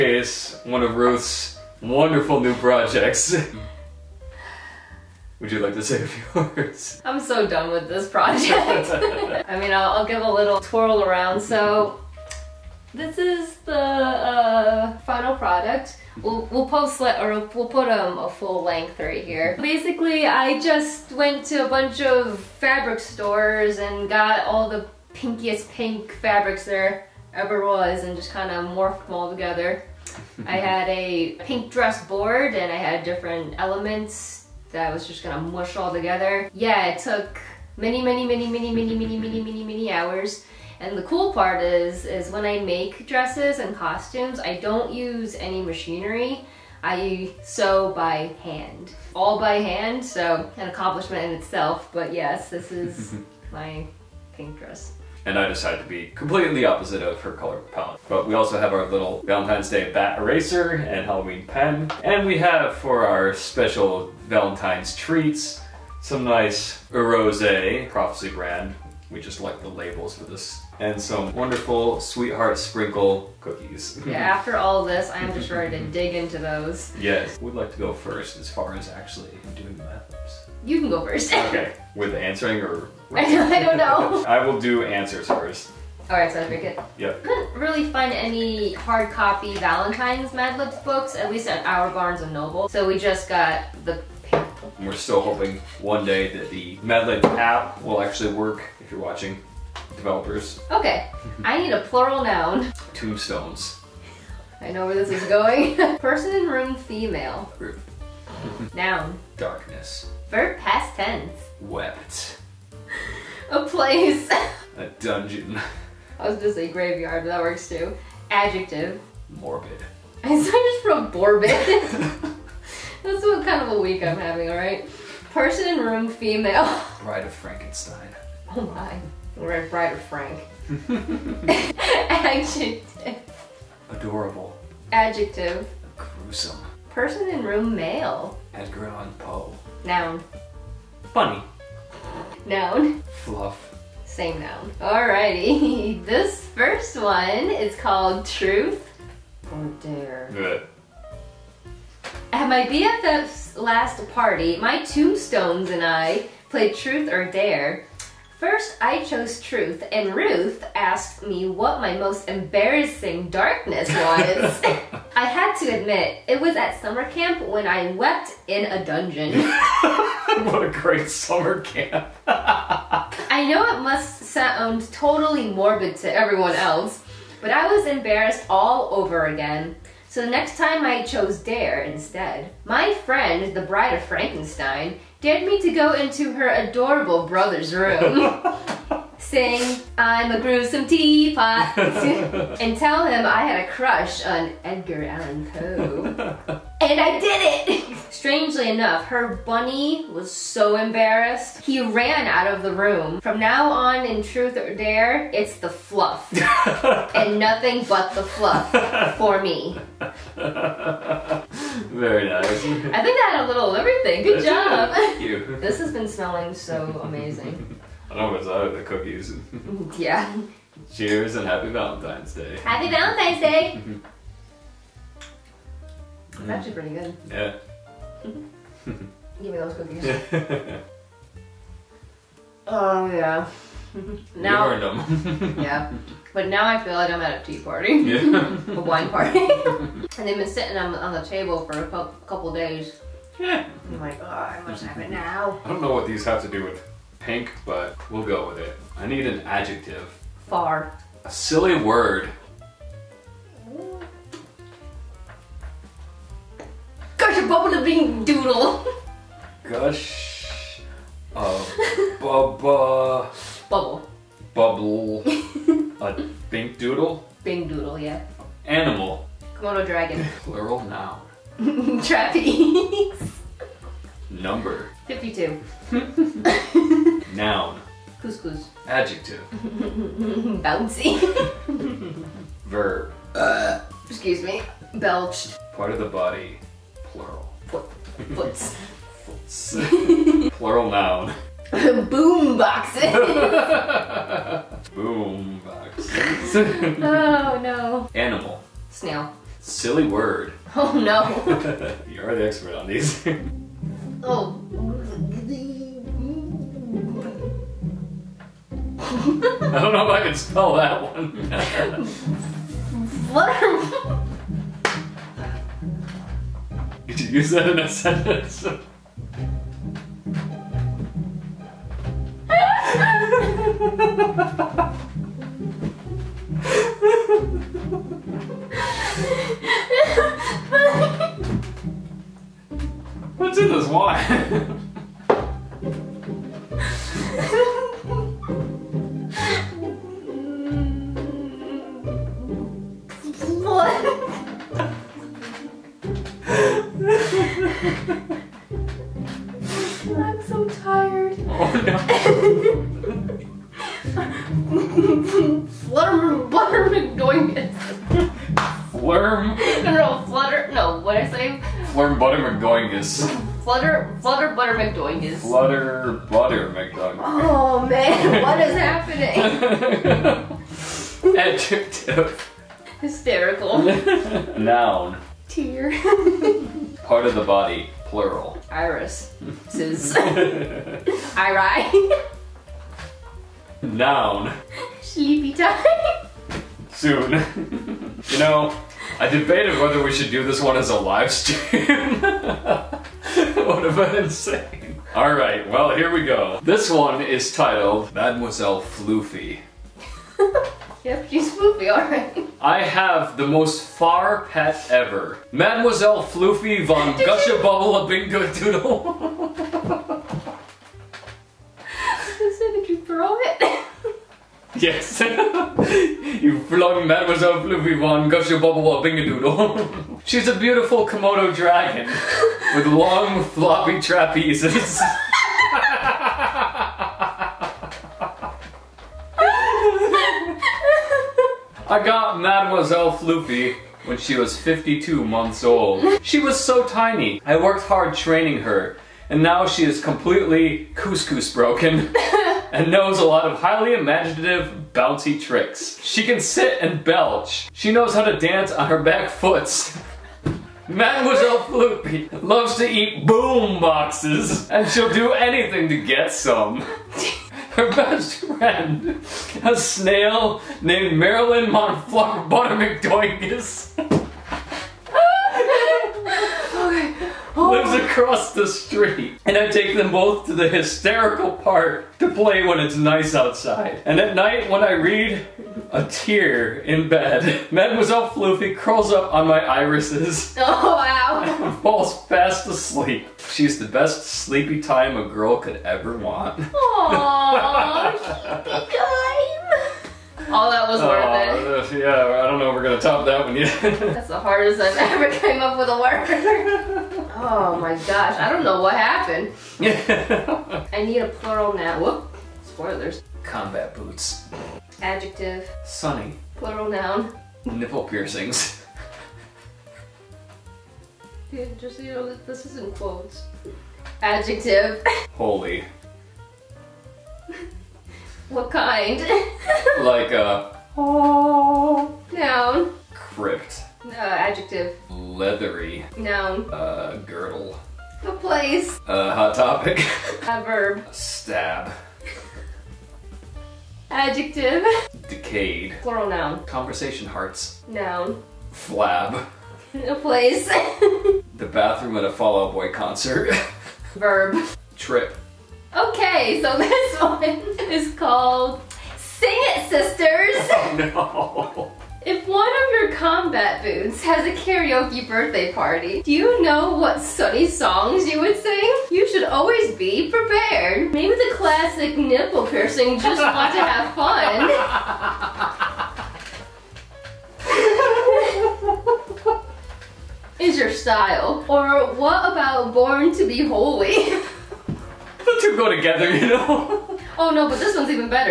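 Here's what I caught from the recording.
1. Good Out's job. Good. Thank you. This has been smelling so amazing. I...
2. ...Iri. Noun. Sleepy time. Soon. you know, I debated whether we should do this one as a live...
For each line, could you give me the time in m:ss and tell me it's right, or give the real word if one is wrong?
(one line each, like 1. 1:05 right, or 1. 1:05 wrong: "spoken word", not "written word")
1. 3:34 wrong: "That", not "Out"
2. 6:20 right.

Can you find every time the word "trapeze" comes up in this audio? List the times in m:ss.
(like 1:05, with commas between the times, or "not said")
4:32, 7:03.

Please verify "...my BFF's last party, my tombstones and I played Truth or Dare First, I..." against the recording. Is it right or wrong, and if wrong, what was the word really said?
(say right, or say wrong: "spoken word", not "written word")
right.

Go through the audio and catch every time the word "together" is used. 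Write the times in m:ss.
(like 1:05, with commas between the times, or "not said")
0:29, 0:35, 9:35.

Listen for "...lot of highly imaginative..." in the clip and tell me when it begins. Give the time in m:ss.
7:23.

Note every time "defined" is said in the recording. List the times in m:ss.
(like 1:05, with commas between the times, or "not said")
not said.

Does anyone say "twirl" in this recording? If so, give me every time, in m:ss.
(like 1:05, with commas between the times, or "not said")
0:10.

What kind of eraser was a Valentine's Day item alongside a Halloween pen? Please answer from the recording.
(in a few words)
bat eraser.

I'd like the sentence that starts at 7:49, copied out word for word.
And I take them both to the hysterical park to play when it's nice outside.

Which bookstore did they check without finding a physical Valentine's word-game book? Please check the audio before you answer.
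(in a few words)
Barnes and Noble.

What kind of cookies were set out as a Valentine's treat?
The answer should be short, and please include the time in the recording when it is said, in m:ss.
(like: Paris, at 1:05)
Sweetheart Sprinkle cookies, at 1:12.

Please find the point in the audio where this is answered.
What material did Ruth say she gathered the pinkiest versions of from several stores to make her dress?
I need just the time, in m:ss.
0:25.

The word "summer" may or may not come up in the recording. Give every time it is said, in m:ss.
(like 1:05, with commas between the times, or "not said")
2:46, 2:51.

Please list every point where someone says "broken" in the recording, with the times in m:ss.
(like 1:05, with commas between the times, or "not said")
7:21.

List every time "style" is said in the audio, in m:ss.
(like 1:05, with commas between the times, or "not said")
9:30.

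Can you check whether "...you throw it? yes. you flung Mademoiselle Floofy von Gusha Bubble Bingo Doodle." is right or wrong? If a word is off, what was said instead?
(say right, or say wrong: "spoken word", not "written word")
right.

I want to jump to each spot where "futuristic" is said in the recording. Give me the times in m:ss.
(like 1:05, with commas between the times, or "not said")
not said.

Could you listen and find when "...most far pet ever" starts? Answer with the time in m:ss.
6:43.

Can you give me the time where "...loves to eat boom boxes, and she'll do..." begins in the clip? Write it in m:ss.
7:32.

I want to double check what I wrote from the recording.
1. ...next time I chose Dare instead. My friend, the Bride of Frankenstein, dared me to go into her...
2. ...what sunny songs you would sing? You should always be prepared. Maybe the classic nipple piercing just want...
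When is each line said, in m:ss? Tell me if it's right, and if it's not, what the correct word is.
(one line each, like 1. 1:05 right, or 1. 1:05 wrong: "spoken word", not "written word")
1. 3:00 right
2. 9:16 right.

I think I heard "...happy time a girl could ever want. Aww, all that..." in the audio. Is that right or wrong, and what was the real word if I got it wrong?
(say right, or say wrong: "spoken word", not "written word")
wrong: "sleepy", not "happy".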